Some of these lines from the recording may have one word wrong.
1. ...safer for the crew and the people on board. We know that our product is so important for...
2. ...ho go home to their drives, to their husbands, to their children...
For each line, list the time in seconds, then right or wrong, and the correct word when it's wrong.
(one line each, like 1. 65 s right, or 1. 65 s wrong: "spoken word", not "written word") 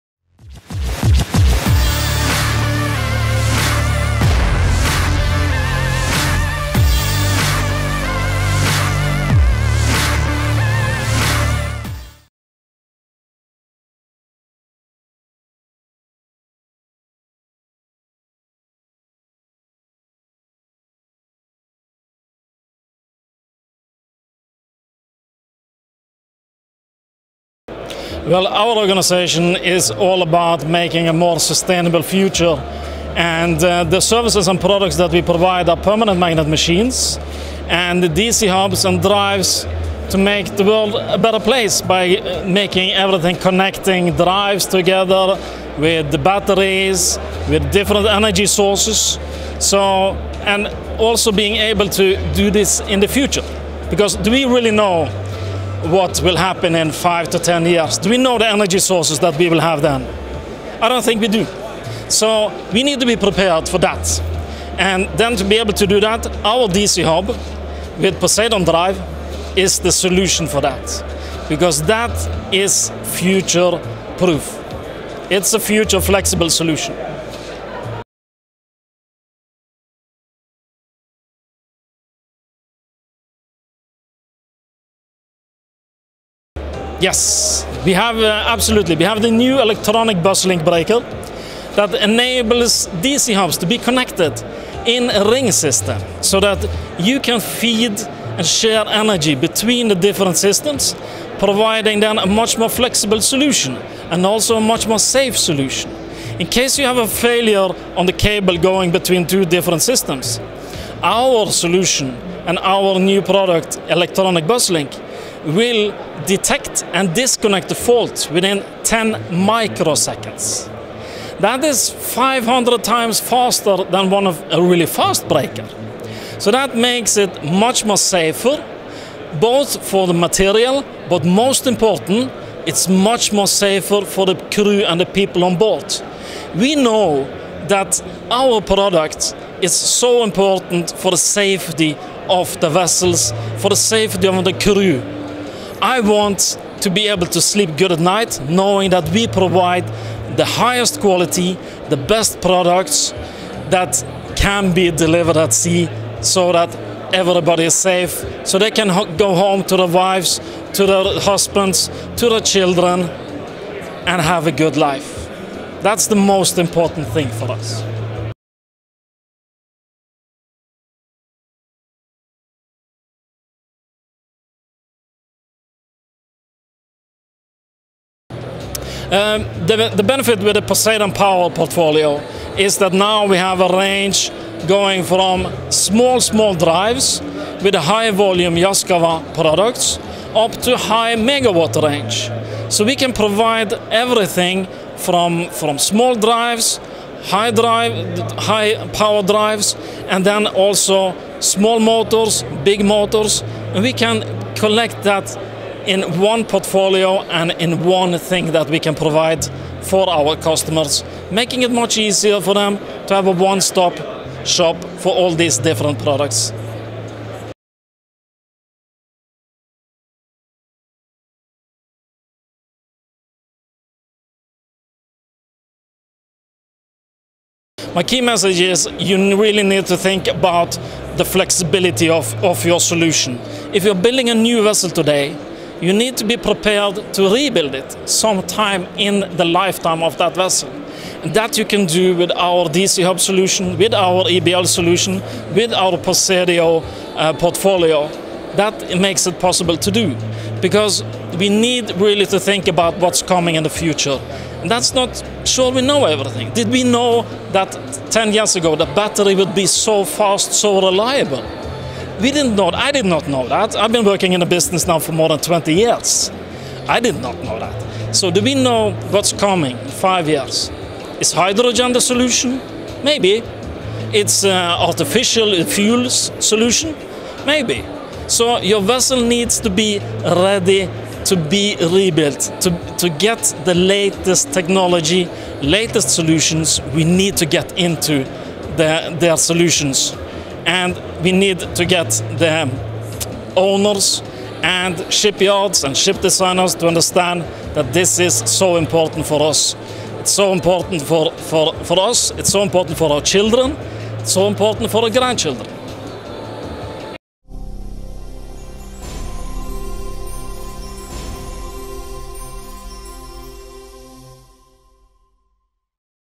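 1. 133 s right
2. 158 s wrong: "wives", not "drives".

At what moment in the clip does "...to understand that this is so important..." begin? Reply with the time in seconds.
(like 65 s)
296 s.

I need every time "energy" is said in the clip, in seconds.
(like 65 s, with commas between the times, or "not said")
48 s, 58 s, 98 s.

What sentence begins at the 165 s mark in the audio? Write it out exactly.
That's the most important thing for us.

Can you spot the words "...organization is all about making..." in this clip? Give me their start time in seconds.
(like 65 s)
28 s.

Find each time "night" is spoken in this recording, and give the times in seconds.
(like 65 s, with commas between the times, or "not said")
147 s.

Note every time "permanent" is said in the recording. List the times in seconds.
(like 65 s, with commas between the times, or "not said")
35 s.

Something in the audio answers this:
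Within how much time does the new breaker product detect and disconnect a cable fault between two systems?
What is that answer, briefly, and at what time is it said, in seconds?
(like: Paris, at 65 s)
10 microseconds, at 118 s.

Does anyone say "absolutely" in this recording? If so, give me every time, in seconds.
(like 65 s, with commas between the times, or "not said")
88 s.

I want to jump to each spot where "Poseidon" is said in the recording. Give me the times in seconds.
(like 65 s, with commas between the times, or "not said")
68 s, 180 s, 245 s.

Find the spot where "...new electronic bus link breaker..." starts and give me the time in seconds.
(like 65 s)
89 s.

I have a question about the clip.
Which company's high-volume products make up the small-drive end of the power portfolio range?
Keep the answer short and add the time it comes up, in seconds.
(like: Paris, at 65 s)
Yaskawa, at 188 s.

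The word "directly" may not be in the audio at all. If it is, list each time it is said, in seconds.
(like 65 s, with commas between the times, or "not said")
not said.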